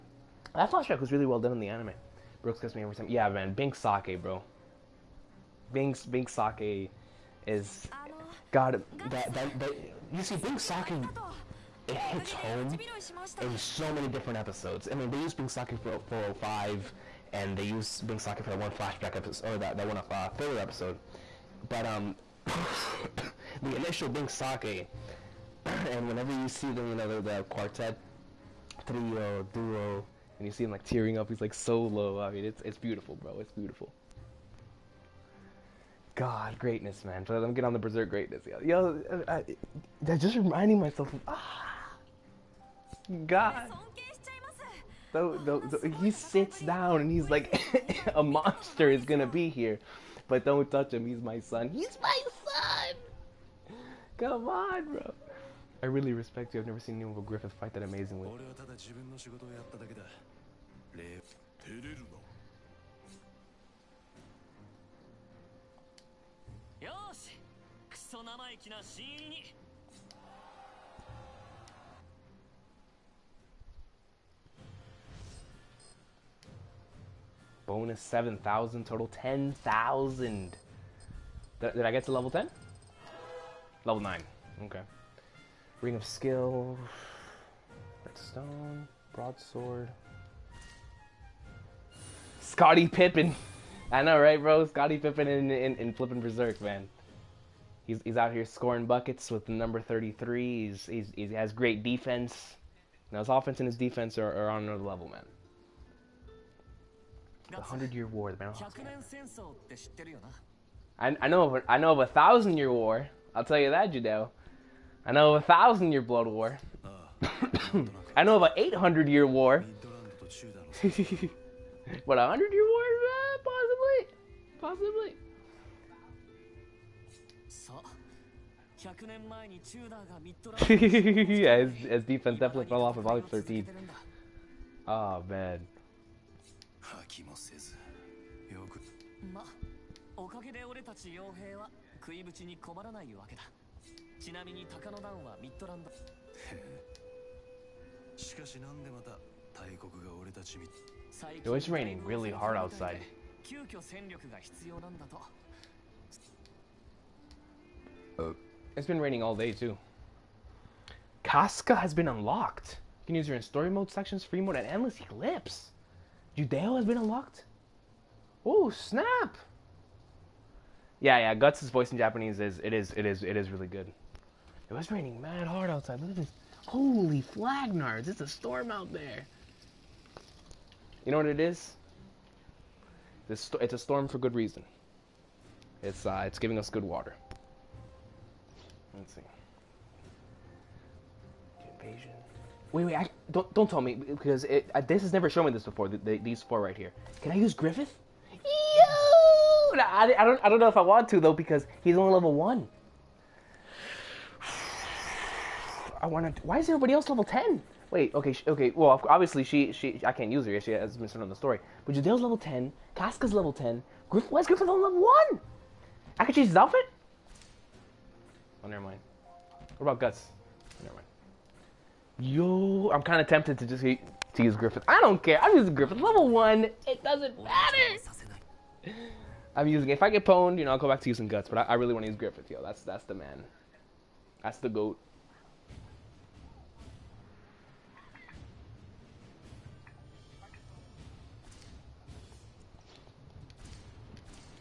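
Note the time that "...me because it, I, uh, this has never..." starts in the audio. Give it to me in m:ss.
3:13.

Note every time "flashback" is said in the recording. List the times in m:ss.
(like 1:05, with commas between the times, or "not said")
0:00, 0:18.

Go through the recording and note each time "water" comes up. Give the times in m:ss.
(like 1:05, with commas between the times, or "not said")
3:06.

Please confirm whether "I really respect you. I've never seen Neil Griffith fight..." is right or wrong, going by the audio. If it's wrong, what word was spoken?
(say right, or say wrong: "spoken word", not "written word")
right.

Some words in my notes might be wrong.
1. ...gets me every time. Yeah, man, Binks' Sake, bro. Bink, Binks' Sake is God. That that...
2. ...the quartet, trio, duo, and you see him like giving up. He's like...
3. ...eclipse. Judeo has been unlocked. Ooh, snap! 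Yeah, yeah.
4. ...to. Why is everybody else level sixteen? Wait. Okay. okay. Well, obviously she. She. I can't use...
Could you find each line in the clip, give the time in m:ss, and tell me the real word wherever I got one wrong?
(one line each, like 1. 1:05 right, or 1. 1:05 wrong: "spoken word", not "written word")
1. 0:02 right
2. 0:27 wrong: "tearing", not "giving"
3. 2:44 right
4. 3:26 wrong: "ten", not "sixteen".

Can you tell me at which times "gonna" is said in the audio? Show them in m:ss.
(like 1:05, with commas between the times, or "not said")
0:49.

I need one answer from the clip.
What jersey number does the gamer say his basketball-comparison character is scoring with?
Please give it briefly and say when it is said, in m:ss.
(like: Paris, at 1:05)
33, at 1:39.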